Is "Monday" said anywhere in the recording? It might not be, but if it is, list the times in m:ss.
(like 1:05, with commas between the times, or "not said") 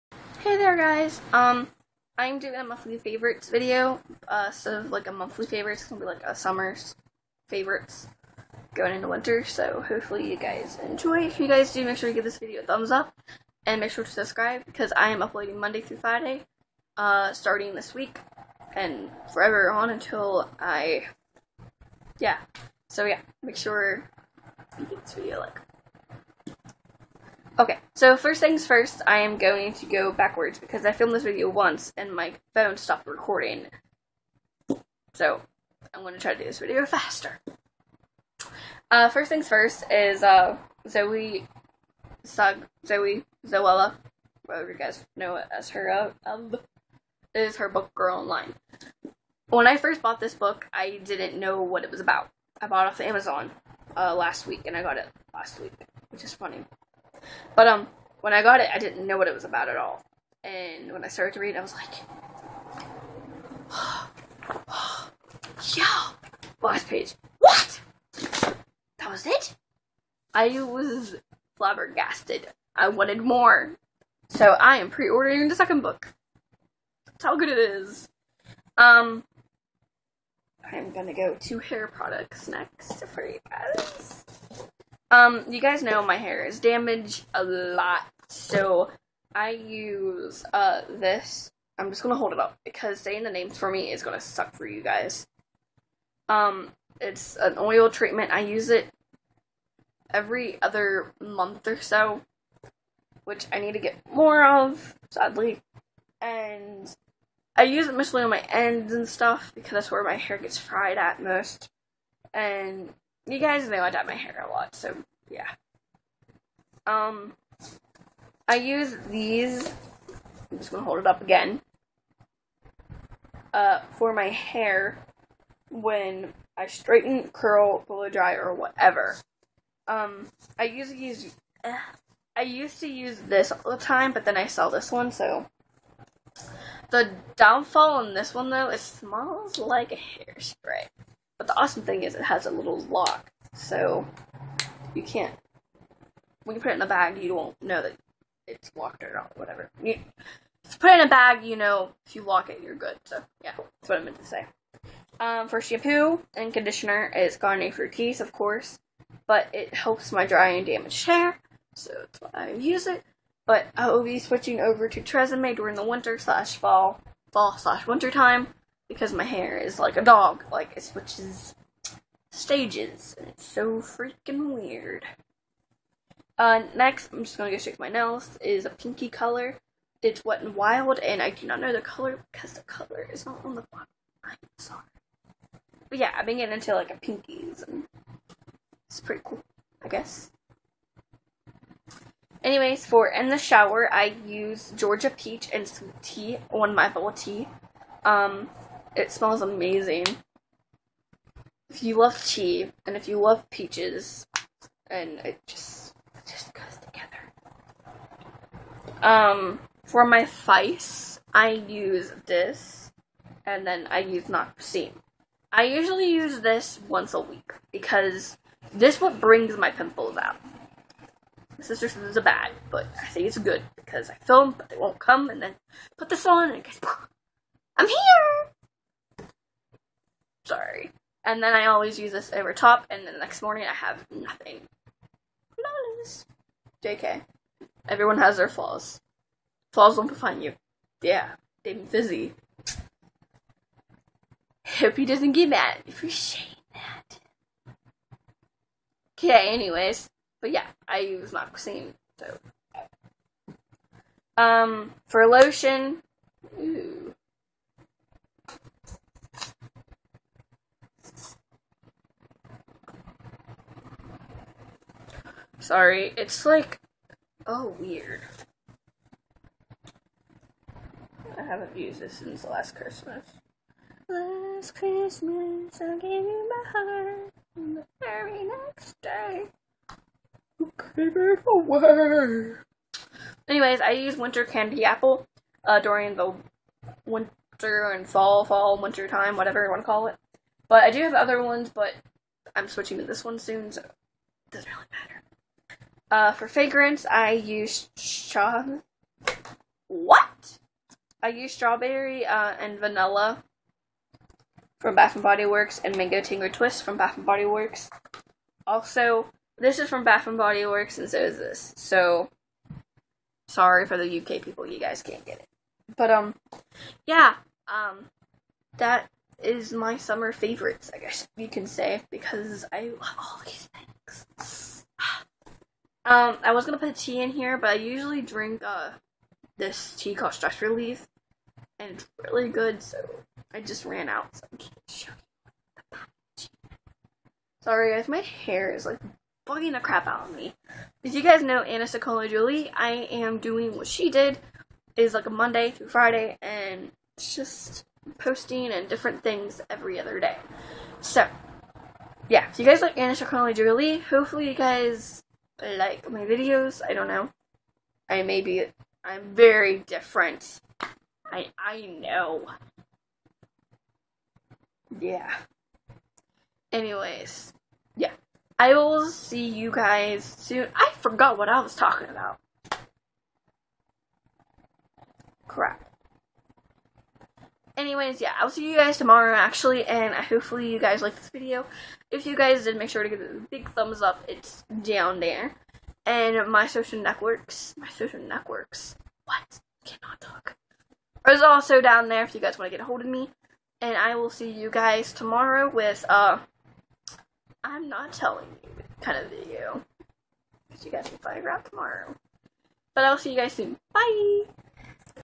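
0:15, 5:45.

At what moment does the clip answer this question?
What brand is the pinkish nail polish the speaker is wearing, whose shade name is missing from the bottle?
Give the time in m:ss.
3:00.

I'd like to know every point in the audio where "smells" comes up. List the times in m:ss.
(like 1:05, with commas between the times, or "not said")
2:18, 3:19.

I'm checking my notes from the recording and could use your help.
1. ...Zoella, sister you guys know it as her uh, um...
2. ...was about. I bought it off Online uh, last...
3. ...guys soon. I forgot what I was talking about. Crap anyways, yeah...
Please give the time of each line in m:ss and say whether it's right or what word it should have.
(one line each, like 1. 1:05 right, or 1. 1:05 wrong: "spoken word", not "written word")
1. 0:43 wrong: "whatever", not "sister"
2. 0:51 wrong: "Amazon", not "Online"
3. 6:09 right.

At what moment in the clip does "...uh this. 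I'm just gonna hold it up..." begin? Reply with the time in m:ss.
1:30.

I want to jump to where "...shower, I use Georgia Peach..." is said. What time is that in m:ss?
3:13.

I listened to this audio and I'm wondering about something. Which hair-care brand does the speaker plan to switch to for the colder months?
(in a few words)
Tresemme.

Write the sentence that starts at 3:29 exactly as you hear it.
Um, for my face, I use this, and then I use Noxine.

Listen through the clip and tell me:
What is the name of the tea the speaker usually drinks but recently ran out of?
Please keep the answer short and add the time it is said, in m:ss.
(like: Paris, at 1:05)
Stress Relief, at 5:30.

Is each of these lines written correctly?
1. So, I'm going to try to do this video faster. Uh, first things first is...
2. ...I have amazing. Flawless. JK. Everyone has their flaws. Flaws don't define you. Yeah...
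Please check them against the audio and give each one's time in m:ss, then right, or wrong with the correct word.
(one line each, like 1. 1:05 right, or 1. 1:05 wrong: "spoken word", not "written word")
1. 0:35 right
2. 3:53 wrong: "nothing", not "amazing".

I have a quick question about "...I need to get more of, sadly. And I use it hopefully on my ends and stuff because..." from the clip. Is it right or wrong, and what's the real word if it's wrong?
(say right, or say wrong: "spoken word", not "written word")
wrong: "mostly", not "hopefully".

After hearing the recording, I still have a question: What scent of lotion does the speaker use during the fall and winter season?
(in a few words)
Winter Candy Apple.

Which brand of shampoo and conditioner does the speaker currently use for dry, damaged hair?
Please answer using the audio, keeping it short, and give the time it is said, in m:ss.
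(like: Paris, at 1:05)
Garnier Fructis, at 2:37.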